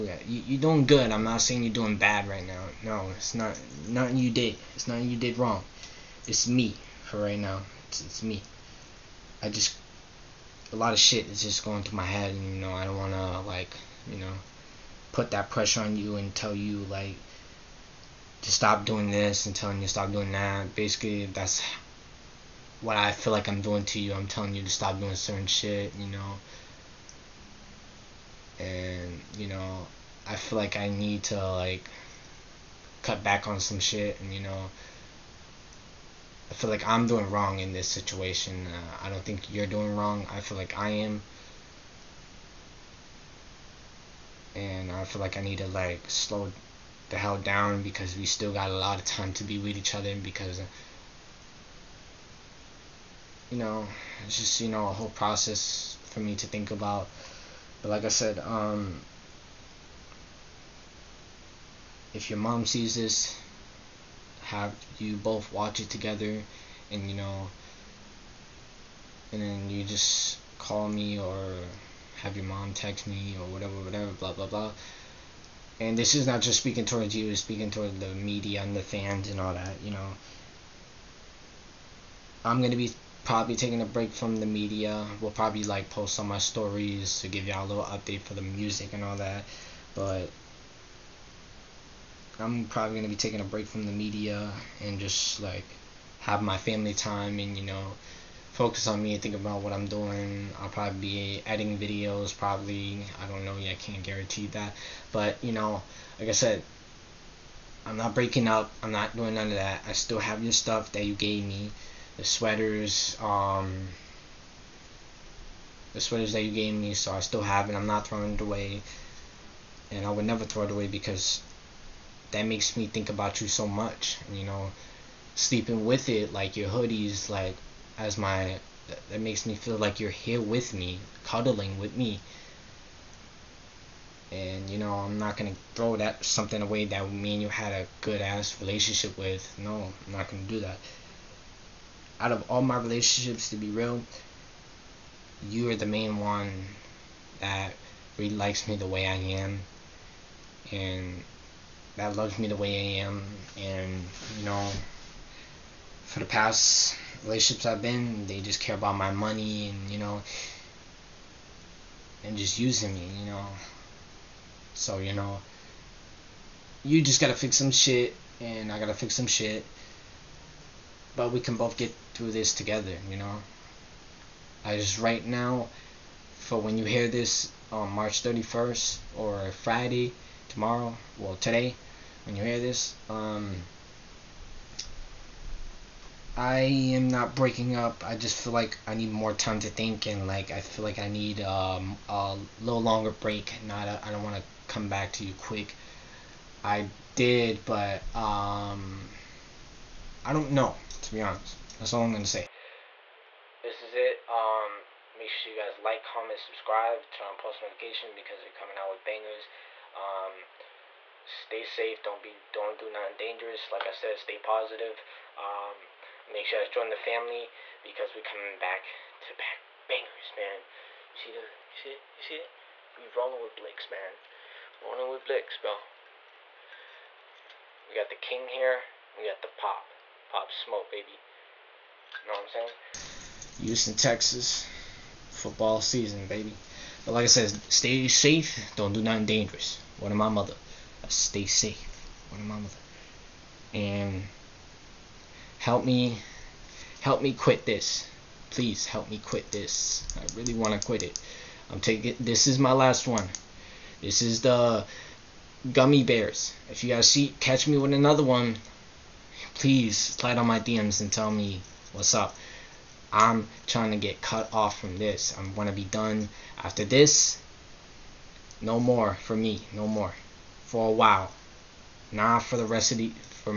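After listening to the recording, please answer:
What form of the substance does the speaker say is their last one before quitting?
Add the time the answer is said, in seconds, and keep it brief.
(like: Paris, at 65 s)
Gummy bears, at 255 s.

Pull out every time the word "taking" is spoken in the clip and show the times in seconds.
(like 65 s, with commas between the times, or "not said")
83 s, 93 s, 251 s.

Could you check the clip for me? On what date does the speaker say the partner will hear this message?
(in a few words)
March 31st.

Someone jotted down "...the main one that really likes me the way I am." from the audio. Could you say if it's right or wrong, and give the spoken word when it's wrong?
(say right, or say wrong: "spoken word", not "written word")
right.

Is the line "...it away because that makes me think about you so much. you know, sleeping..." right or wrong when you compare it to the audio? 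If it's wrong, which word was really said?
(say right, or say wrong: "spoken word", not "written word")
right.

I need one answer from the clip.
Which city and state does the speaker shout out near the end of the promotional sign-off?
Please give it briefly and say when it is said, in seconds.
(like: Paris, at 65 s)
Houston, Texas, at 233 s.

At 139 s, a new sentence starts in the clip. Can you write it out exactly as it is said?
No, I'm not gonna do that.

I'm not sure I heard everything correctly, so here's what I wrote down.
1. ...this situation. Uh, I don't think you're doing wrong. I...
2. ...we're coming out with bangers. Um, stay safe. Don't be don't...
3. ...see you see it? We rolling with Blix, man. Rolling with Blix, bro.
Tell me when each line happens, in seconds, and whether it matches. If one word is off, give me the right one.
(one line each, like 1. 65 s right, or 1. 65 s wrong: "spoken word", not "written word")
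1. 37 s right
2. 208 s right
3. 221 s right.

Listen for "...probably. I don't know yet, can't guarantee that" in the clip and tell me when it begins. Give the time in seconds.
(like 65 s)
102 s.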